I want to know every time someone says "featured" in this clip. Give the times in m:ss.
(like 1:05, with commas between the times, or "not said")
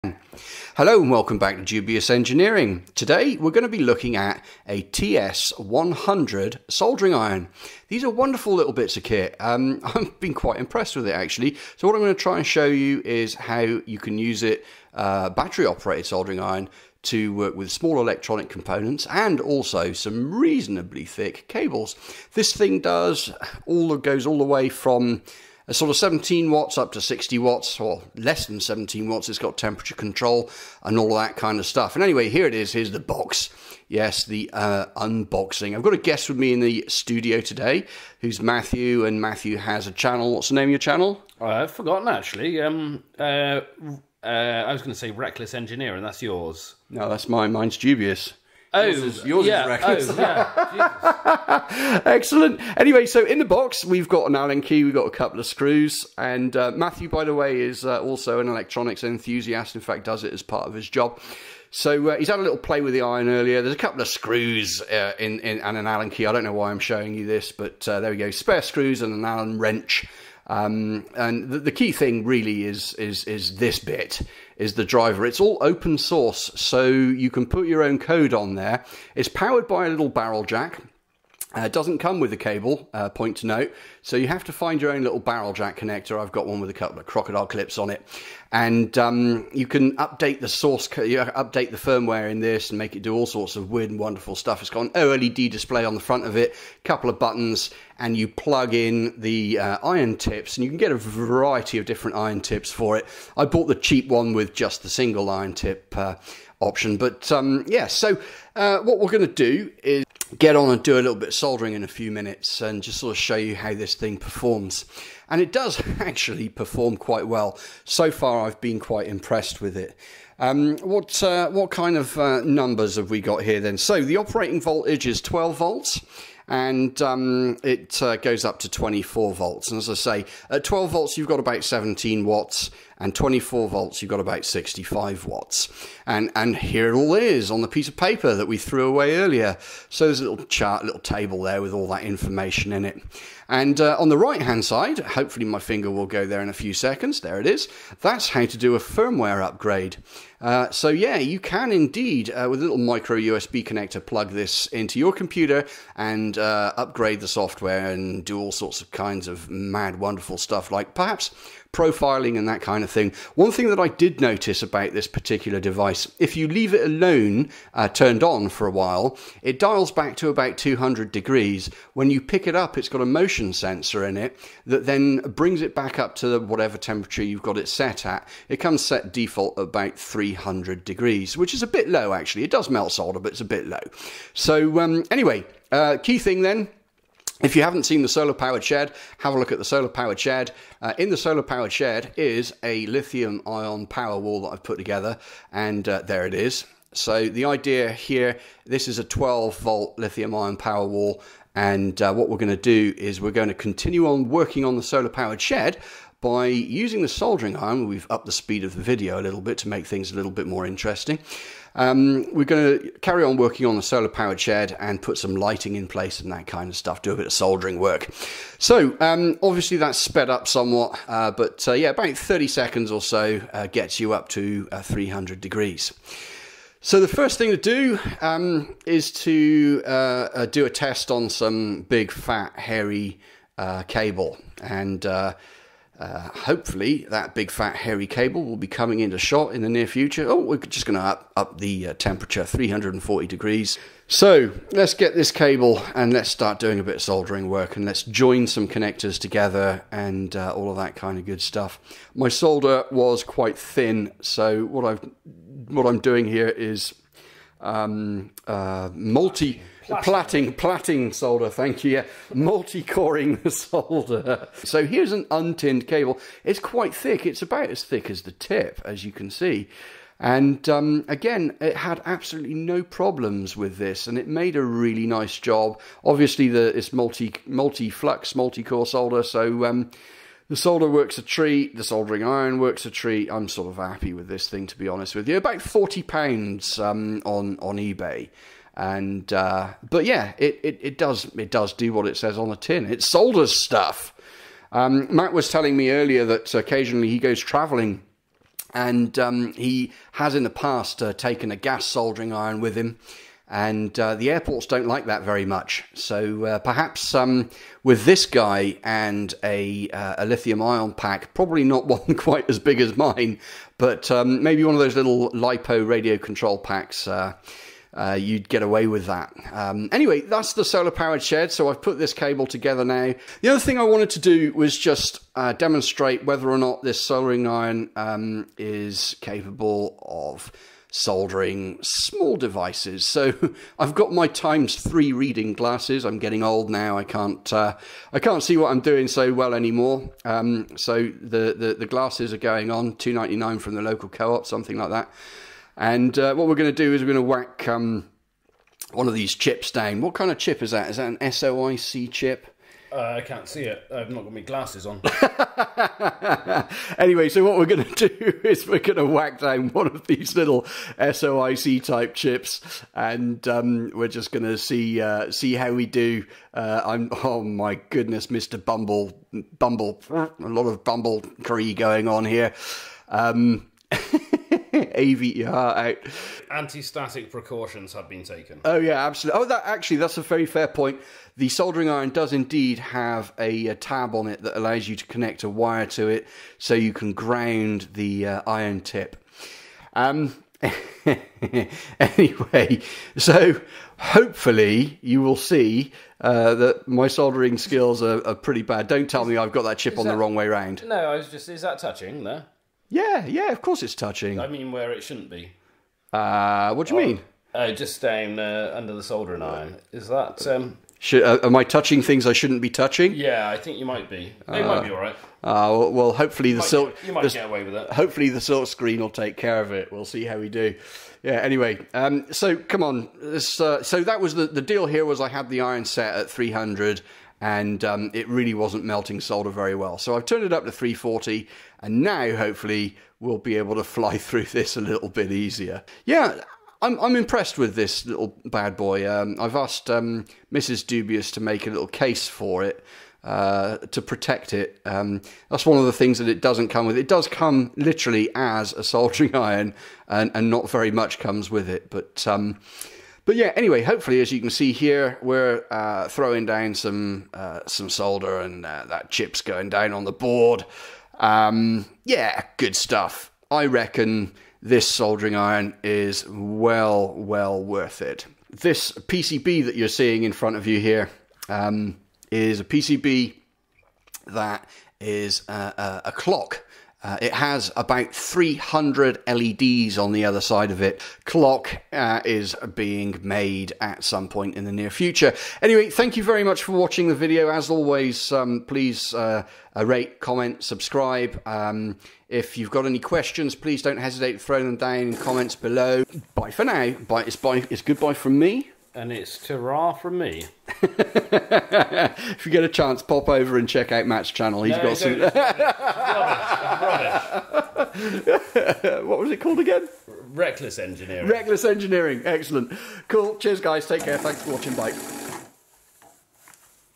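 not said.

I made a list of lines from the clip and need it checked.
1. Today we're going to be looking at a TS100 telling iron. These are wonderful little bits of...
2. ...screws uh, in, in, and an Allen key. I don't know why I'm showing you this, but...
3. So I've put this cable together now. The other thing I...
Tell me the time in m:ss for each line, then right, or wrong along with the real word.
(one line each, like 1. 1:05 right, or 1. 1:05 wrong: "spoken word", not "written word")
1. 0:02 wrong: "soldering", not "telling"
2. 1:04 right
3. 5:21 right.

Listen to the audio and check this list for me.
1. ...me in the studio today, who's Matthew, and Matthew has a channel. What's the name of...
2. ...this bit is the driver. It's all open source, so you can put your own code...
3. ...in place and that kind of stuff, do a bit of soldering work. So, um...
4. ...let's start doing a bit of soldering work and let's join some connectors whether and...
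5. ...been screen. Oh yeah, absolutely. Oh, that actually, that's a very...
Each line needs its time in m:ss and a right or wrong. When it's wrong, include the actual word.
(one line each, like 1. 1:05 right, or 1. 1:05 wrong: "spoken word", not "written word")
1. 0:36 right
2. 1:13 right
3. 3:35 right
4. 4:06 wrong: "together", not "whether"
5. 6:18 wrong: "taken", not "screen".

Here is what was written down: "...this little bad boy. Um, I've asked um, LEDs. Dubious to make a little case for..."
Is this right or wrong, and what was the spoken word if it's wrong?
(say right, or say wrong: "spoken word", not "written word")
wrong: "Mrs", not "LEDs".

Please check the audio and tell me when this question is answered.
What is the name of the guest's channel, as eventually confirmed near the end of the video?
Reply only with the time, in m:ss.
8:30.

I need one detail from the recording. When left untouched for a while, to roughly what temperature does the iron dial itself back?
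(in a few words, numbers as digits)
200 degrees.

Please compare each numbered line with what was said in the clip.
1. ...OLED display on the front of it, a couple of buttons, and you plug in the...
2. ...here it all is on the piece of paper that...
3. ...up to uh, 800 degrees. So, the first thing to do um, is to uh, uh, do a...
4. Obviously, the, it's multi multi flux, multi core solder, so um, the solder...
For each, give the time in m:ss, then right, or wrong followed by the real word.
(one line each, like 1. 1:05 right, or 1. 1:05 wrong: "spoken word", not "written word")
1. 1:34 right
2. 2:16 right
3. 3:44 wrong: "300", not "800"
4. 4:36 right.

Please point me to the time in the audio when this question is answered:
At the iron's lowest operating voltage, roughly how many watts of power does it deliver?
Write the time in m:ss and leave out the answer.
2:11.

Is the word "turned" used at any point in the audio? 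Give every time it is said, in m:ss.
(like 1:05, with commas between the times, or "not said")
2:47, 7:10.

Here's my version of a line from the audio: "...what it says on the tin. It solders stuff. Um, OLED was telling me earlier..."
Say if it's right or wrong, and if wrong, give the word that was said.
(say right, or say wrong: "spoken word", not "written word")
wrong: "Matt", not "OLED".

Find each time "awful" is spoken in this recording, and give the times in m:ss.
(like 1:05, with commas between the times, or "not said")
not said.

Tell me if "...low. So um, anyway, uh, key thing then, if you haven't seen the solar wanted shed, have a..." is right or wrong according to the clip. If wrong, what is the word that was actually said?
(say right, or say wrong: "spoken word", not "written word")
wrong: "powered", not "wanted".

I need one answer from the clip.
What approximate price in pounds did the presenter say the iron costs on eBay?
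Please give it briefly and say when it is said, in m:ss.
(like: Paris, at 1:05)
40 pounds, at 4:45.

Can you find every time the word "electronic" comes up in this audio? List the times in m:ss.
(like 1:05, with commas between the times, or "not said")
0:18, 0:58.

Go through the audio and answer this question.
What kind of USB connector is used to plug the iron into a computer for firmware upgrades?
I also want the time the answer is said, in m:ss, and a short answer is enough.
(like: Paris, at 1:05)
micro USB, at 2:32.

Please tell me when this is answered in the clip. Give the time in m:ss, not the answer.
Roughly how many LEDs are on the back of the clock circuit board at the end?
7:57.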